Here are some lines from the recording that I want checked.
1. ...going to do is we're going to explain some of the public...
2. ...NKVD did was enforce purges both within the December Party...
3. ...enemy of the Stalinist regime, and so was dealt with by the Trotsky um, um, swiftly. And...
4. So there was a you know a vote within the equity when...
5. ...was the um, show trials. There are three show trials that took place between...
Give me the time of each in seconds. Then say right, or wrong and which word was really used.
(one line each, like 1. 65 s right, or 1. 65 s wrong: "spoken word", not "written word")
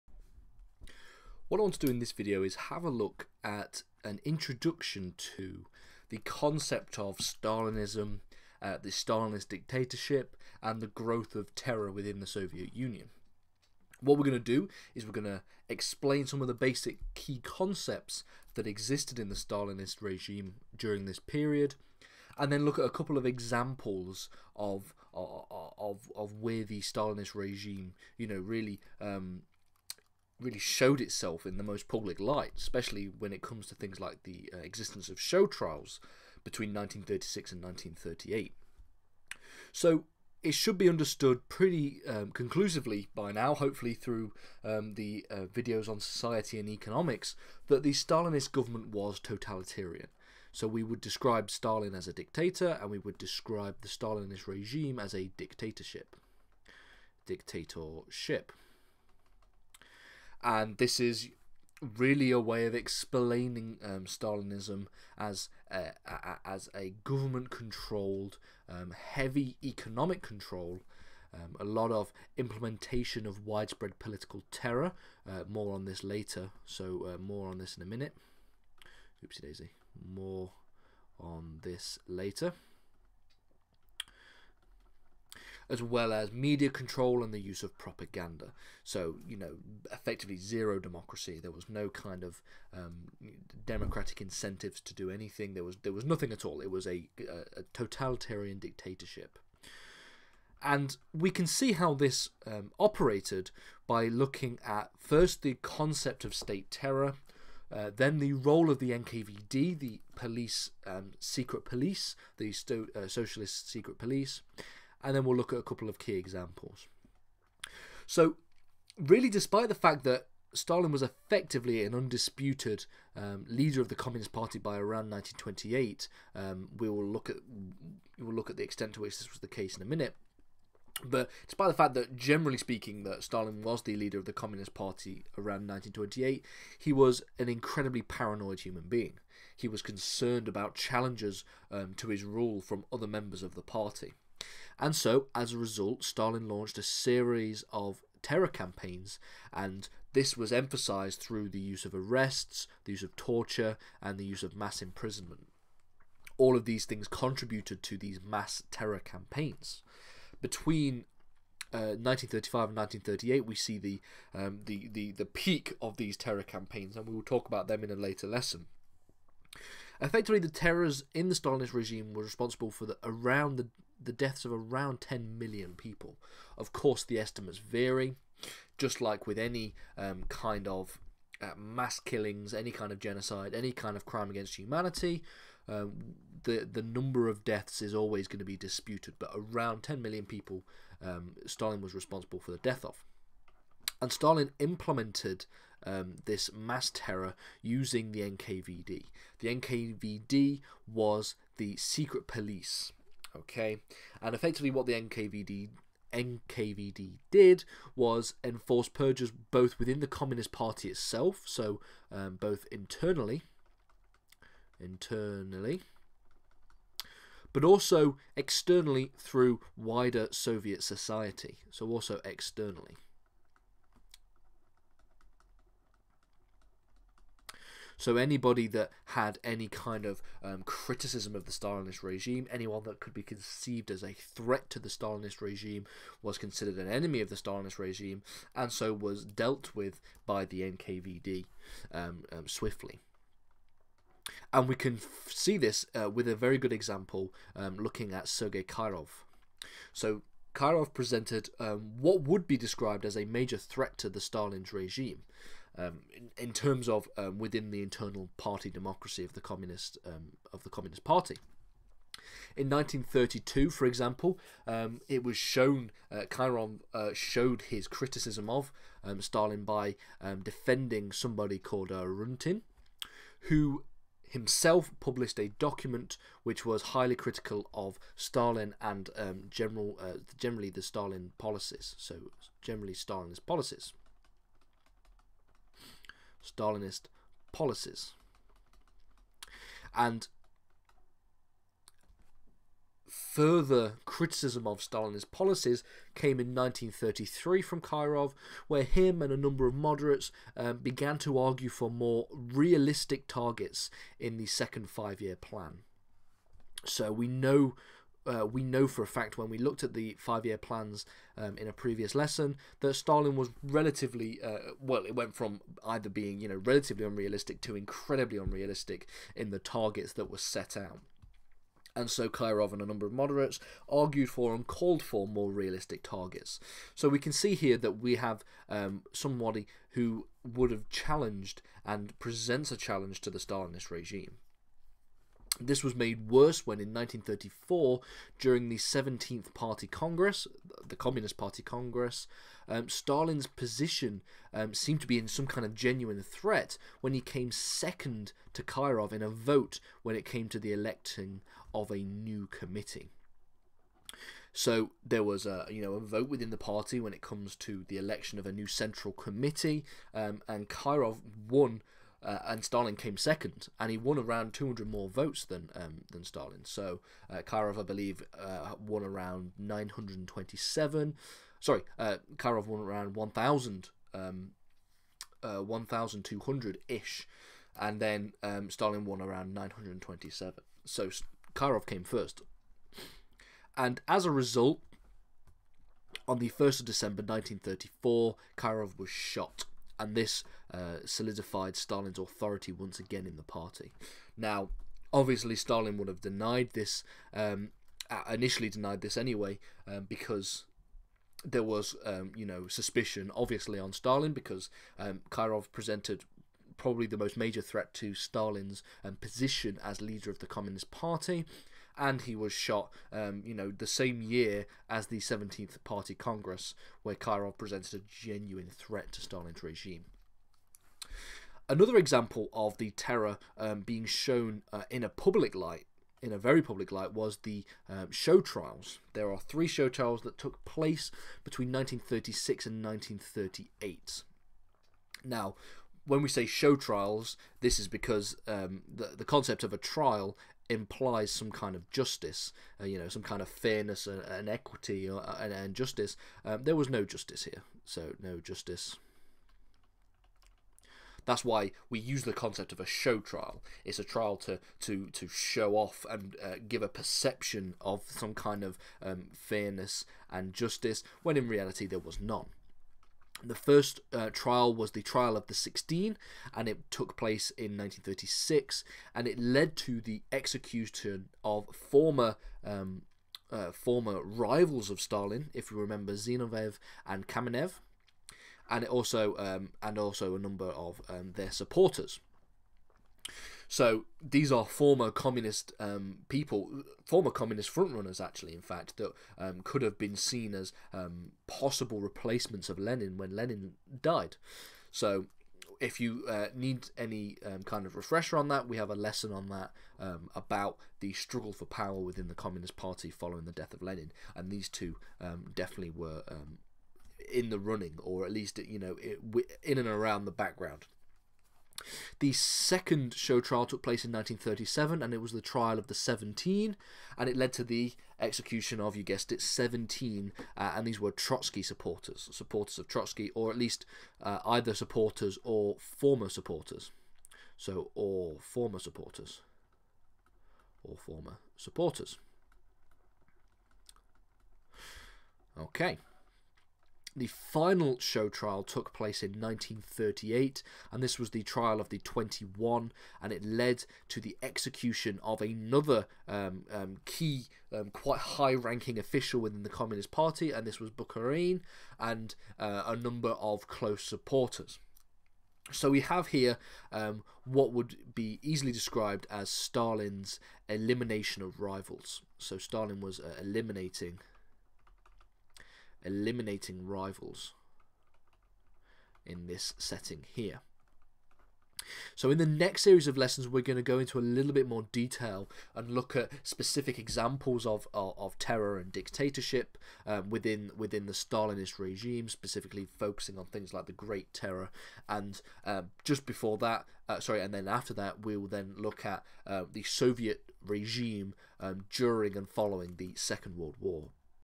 1. 14 s wrong: "basic", not "public"
2. 206 s wrong: "Communist", not "December"
3. 236 s wrong: "NKVD", not "Trotsky"
4. 354 s wrong: "party", not "equity"
5. 427 s right.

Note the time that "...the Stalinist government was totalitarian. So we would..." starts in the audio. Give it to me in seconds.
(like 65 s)
47 s.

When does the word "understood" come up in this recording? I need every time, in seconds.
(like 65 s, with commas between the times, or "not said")
40 s.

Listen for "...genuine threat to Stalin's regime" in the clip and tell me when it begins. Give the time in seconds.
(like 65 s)
418 s.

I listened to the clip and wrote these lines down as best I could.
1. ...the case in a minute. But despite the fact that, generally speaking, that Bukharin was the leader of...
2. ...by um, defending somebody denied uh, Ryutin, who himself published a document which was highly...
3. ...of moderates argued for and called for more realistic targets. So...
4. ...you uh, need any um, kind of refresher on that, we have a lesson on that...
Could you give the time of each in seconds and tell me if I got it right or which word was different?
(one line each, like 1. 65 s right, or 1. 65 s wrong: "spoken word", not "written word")
1. 129 s wrong: "Stalin", not "Bukharin"
2. 269 s wrong: "called", not "denied"
3. 323 s right
4. 496 s right.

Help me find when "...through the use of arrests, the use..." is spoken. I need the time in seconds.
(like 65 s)
151 s.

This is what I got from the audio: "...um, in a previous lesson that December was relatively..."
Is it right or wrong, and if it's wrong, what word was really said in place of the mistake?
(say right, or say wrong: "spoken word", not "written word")
wrong: "Stalin", not "December".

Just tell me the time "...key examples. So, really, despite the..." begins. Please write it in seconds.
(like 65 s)
115 s.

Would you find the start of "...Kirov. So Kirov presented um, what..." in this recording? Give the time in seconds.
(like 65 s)
248 s.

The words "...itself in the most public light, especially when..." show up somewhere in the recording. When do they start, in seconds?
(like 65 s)
30 s.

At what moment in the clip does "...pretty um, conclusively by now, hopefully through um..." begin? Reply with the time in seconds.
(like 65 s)
41 s.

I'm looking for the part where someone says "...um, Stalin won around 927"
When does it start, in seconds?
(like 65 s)
378 s.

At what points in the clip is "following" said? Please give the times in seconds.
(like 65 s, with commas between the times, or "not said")
503 s, 592 s.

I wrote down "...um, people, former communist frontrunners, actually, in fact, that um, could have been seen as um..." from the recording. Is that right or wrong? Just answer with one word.
right.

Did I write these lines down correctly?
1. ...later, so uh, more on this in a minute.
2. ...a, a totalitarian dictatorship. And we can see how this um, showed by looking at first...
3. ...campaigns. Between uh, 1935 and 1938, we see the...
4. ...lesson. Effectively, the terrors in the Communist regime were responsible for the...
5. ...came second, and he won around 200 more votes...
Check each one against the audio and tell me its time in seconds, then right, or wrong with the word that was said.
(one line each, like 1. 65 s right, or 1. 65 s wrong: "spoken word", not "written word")
1. 76 s right
2. 97 s wrong: "operated", not "showed"
3. 158 s right
4. 168 s wrong: "Stalinist", not "Communist"
5. 362 s right.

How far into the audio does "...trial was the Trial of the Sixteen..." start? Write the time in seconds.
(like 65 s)
464 s.